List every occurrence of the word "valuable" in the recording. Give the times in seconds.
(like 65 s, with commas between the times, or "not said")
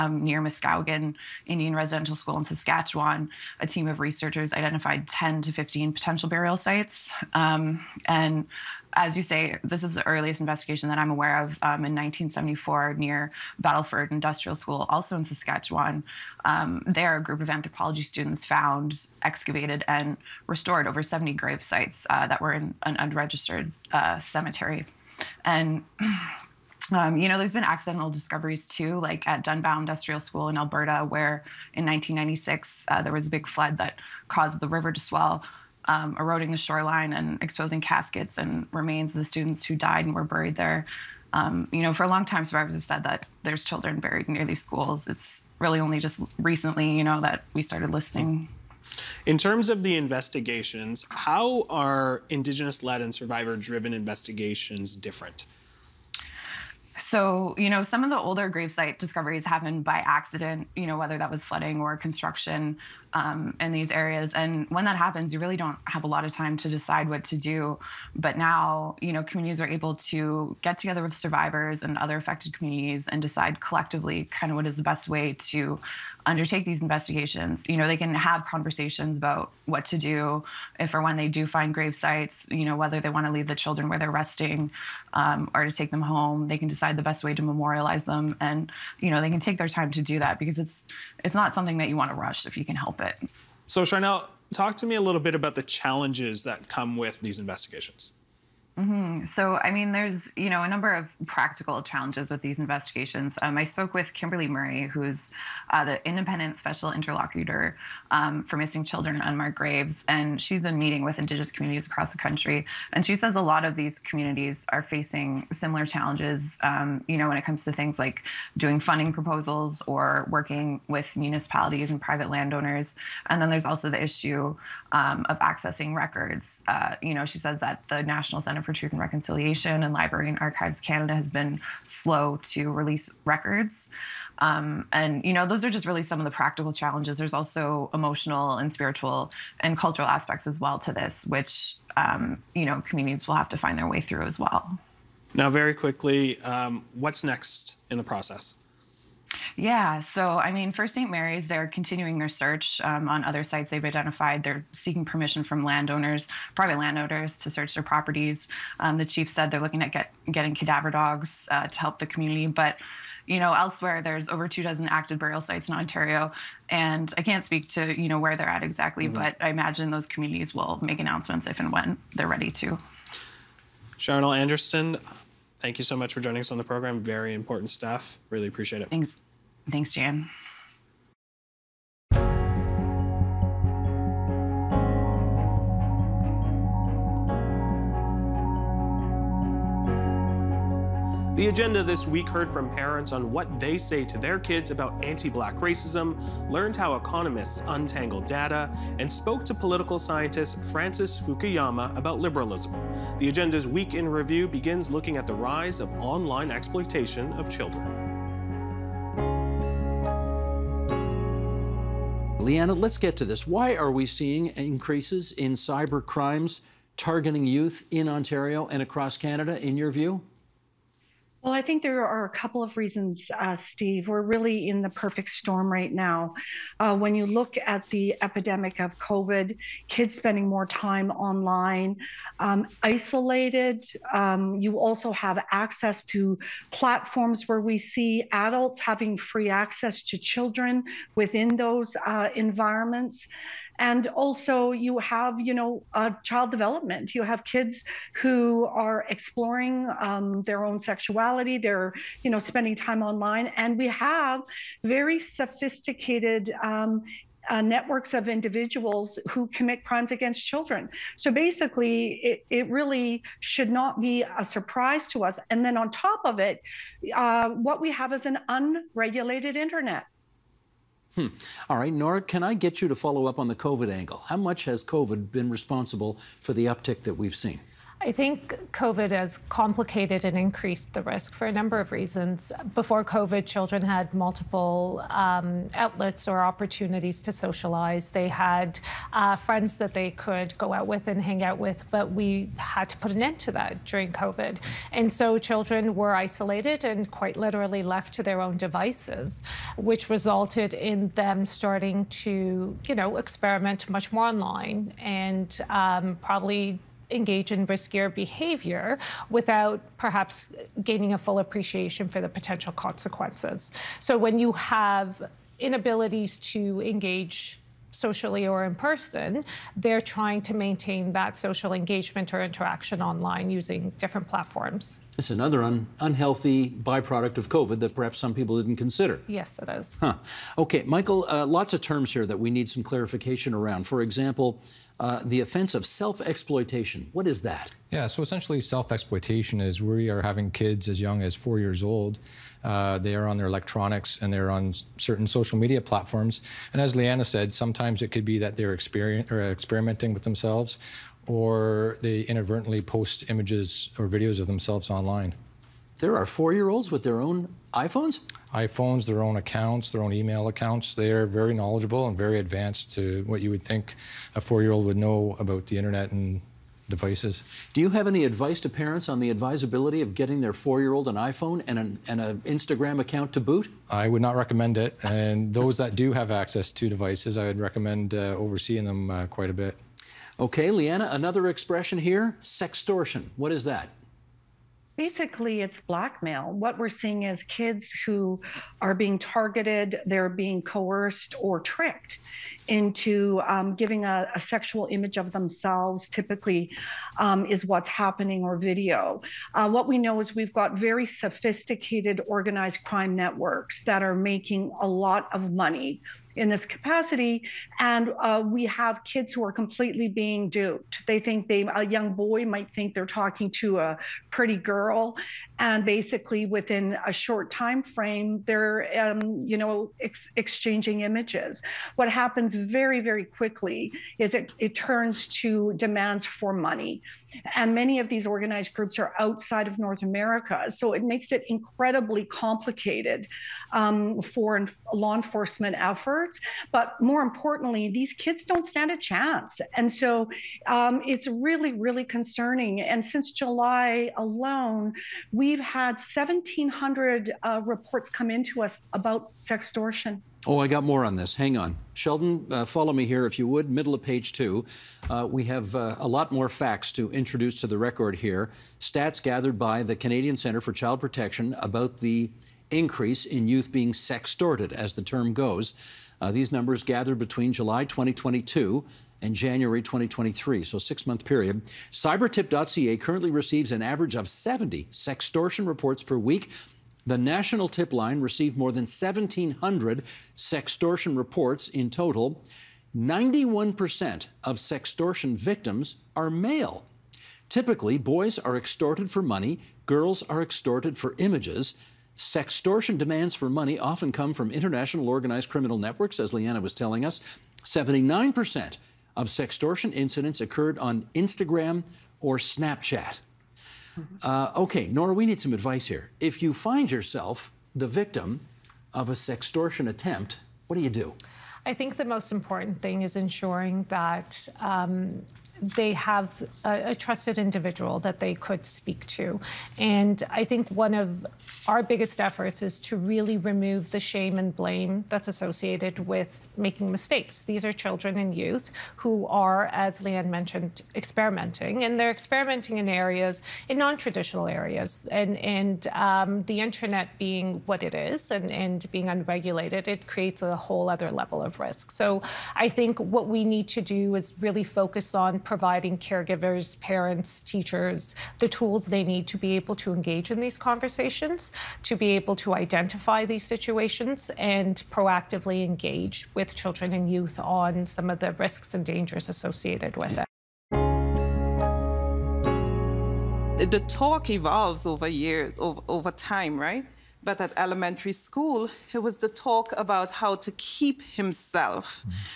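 not said.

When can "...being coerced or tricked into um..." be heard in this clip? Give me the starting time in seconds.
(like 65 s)
390 s.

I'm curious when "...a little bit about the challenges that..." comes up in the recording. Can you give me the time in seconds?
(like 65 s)
94 s.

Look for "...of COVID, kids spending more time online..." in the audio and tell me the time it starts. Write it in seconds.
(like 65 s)
228 s.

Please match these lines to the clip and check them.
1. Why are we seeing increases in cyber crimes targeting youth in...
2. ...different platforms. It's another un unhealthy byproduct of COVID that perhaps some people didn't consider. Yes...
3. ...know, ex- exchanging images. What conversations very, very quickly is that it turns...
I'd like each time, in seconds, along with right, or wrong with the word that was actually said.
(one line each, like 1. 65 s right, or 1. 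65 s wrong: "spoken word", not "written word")
1. 213 s right
2. 323 s right
3. 419 s wrong: "happens", not "conversations".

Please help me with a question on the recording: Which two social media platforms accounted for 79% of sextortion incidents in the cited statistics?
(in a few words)
Instagram or Snapchat.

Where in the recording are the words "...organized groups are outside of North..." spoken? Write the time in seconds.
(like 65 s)
428 s.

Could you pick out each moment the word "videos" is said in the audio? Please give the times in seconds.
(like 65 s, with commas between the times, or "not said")
354 s, 398 s.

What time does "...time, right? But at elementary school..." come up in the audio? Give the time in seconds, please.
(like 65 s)
566 s.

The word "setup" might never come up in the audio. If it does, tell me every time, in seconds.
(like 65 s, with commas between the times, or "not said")
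not said.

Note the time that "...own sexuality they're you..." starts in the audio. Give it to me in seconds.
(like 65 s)
250 s.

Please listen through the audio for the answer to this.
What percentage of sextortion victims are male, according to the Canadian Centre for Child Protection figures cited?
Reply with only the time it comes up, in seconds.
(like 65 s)
482 s.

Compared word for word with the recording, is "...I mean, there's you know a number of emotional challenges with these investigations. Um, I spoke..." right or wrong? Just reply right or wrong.
wrong.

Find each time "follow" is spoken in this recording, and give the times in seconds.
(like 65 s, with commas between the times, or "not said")
272 s, 452 s.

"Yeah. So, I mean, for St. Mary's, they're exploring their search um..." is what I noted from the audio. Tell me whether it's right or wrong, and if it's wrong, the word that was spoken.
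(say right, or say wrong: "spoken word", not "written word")
wrong: "continuing", not "exploring".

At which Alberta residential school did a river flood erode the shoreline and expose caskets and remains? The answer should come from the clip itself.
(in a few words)
Dunbow Industrial School.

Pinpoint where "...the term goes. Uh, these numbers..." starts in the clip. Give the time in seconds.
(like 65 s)
464 s.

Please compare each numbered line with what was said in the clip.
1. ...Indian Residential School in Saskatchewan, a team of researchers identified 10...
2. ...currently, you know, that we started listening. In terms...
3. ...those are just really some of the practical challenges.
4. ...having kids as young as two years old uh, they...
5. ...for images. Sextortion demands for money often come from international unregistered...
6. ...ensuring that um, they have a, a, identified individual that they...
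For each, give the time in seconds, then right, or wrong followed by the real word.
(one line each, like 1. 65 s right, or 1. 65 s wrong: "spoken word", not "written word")
1. 1 s right
2. 46 s wrong: "recently", not "currently"
3. 135 s right
4. 340 s wrong: "four", not "two"
5. 490 s wrong: "organized", not "unregistered"
6. 513 s wrong: "trusted", not "identified".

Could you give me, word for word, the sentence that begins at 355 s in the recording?
There are four year olds with their own iPhones?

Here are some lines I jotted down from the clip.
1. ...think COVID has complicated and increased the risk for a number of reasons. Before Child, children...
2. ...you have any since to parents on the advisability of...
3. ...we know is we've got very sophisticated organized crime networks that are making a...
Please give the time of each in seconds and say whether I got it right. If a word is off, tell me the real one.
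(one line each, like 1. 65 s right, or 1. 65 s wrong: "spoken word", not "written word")
1. 278 s wrong: "COVID", not "Child"
2. 367 s wrong: "advice", not "since"
3. 399 s right.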